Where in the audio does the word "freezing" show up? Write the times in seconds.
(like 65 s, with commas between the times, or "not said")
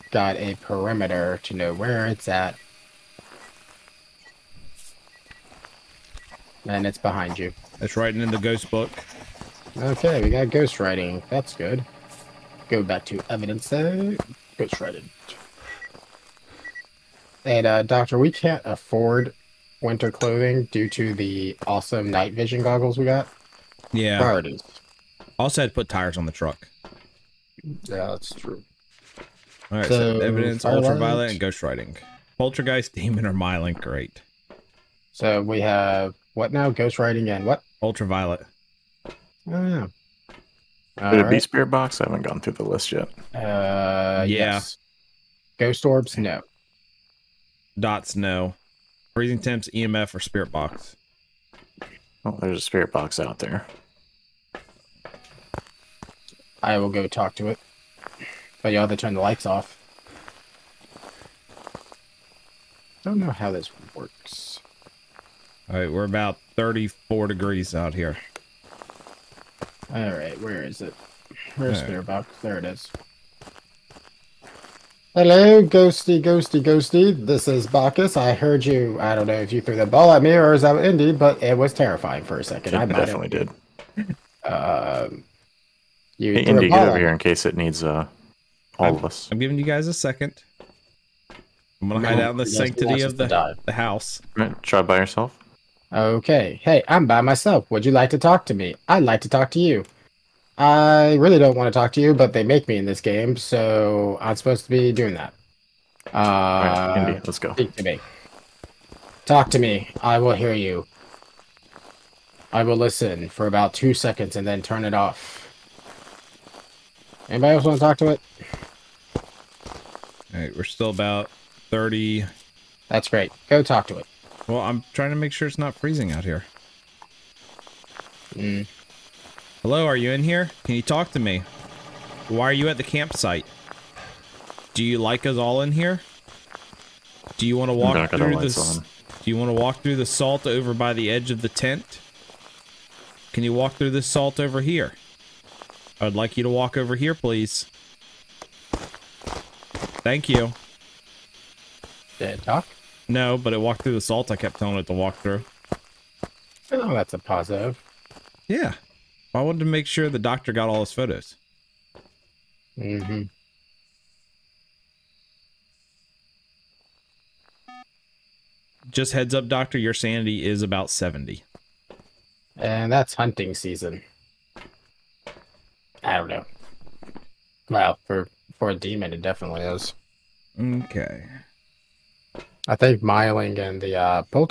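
49 s, 125 s.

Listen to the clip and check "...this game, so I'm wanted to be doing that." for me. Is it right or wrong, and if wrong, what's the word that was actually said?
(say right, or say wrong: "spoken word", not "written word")
wrong: "supposed", not "wanted".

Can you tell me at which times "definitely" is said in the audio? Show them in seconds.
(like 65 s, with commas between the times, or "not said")
82 s, 179 s.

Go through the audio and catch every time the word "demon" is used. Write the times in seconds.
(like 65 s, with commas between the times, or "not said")
32 s, 178 s.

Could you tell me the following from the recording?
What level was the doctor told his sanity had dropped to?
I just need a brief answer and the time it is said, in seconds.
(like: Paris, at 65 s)
70, at 170 s.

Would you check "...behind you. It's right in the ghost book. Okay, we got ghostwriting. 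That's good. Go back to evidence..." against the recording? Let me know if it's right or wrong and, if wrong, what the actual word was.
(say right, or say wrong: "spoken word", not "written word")
right.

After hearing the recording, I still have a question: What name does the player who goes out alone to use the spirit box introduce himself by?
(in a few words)
Bacchus.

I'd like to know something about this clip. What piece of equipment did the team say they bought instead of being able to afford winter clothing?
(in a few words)
Night vision goggles.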